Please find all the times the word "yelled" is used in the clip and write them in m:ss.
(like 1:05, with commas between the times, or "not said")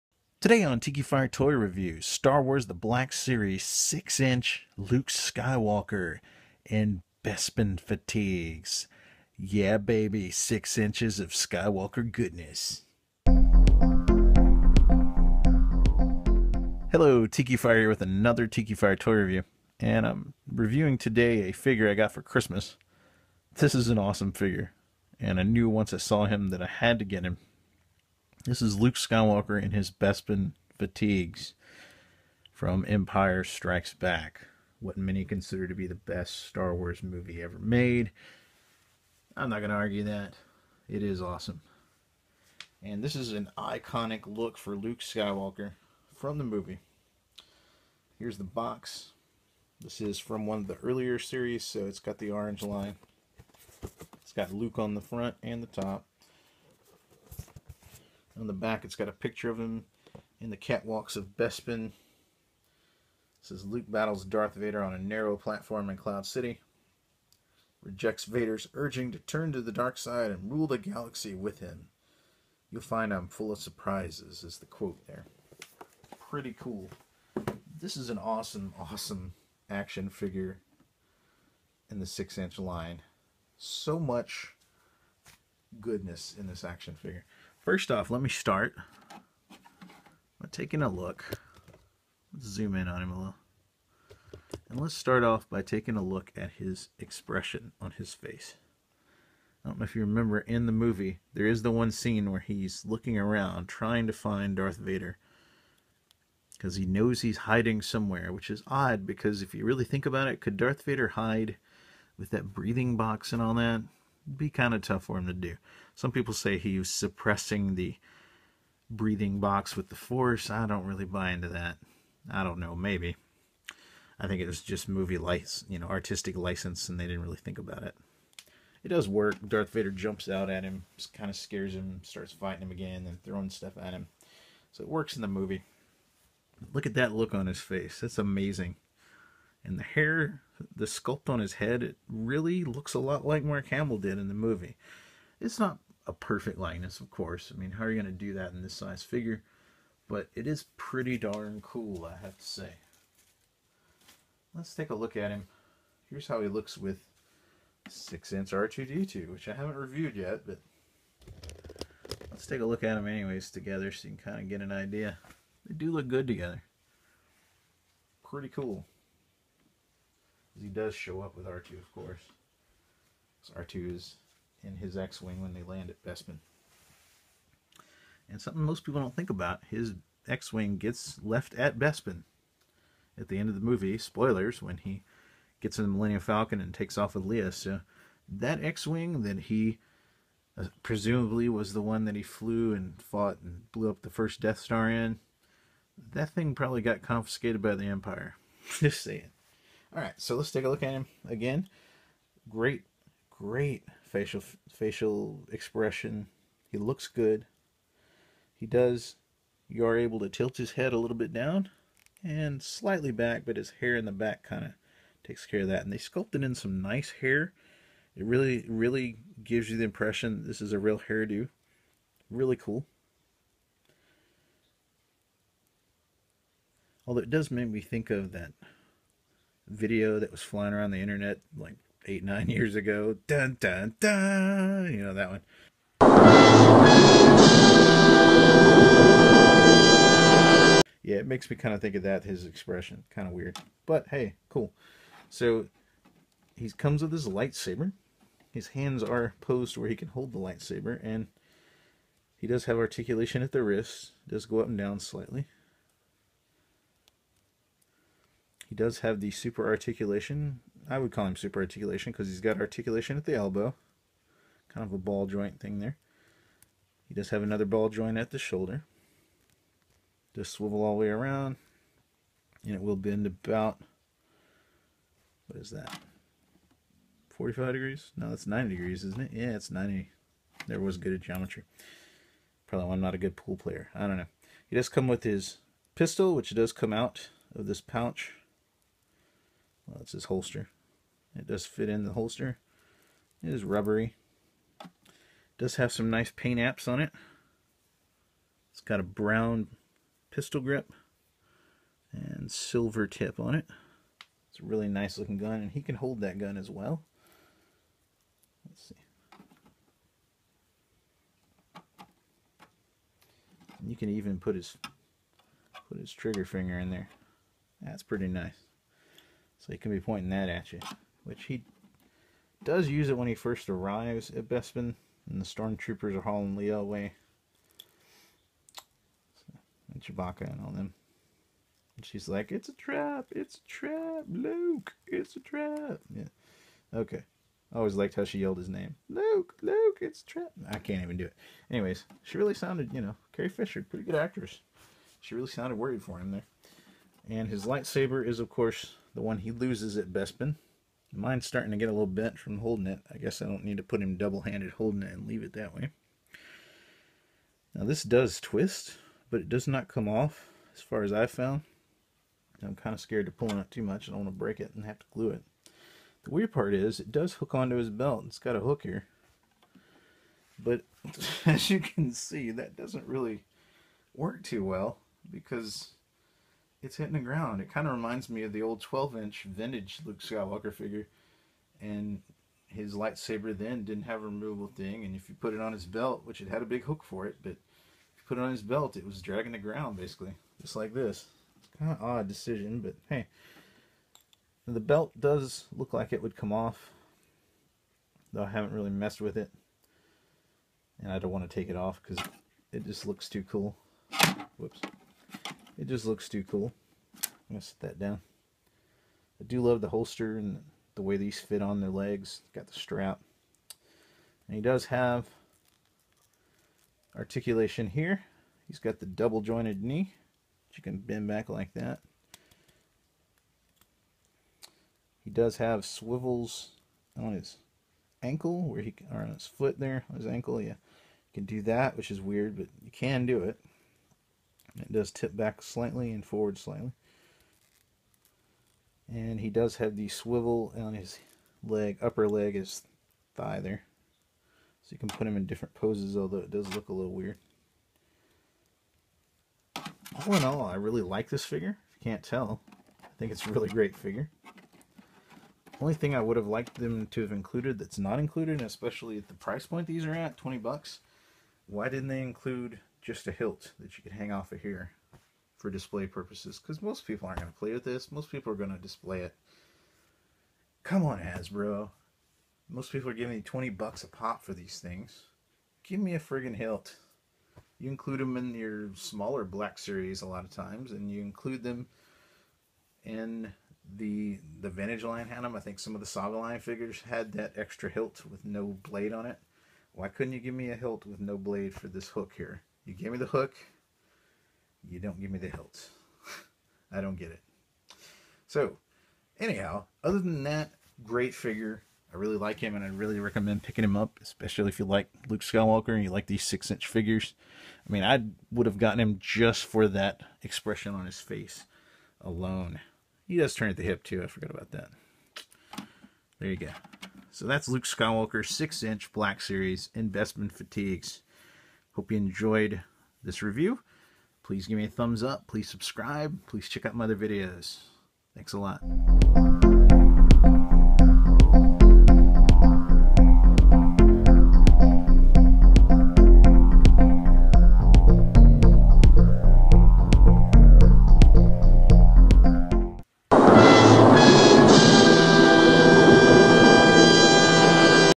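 5:38.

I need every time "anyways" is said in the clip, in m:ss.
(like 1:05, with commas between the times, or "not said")
2:43, 5:41.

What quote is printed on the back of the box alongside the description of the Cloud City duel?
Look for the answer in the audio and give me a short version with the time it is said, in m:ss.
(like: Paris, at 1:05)
You'll find I'm full of surprises, at 1:12.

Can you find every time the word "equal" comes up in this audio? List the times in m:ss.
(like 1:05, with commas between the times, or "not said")
not said.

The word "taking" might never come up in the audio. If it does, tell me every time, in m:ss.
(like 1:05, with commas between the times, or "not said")
1:30, 1:35.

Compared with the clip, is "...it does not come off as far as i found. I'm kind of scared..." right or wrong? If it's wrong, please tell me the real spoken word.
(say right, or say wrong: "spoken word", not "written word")
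right.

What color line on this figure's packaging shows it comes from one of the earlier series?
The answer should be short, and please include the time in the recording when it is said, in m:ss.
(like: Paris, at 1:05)
orange, at 0:52.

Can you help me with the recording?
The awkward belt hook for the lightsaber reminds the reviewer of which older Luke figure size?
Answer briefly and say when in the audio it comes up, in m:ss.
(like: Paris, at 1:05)
12 inch, at 6:18.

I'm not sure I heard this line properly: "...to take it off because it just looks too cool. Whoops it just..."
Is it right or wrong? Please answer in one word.
right.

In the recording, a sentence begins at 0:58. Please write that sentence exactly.
On the back, it's got a picture of him in the catwalks of Bespin.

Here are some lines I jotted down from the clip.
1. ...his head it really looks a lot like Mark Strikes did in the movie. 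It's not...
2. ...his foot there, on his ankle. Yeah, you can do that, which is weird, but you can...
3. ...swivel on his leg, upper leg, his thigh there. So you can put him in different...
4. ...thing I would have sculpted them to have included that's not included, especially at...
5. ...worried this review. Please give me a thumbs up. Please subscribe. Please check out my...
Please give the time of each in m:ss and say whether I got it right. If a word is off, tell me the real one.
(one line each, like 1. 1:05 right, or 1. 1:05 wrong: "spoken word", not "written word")
1. 2:21 wrong: "Hamill", not "Strikes"
2. 7:09 right
3. 7:20 right
4. 7:35 wrong: "liked", not "sculpted"
5. 8:42 wrong: "enjoyed", not "worried".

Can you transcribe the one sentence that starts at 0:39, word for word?
I'm not going to argue that.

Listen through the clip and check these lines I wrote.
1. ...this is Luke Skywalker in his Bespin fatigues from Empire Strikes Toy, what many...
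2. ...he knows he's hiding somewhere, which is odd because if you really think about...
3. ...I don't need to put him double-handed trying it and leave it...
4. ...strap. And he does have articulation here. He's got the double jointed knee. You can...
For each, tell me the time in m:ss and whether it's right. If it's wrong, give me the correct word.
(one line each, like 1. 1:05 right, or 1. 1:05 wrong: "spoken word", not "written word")
1. 0:28 wrong: "Back", not "Toy"
2. 1:46 right
3. 5:53 wrong: "holding", not "trying"
4. 6:52 right.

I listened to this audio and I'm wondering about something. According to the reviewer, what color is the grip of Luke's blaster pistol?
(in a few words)
brown.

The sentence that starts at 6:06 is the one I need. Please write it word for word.
The weird part is it does hook onto his belt.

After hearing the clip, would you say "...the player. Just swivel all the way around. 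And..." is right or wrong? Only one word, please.
wrong.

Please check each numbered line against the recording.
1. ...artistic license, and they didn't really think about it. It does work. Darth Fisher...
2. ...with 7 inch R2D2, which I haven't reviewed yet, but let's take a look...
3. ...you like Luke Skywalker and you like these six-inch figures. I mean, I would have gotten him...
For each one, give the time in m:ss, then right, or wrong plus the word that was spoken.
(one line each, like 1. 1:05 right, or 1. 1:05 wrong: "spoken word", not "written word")
1. 2:05 wrong: "Vader", not "Fisher"
2. 2:36 wrong: "6", not "7"
3. 8:24 right.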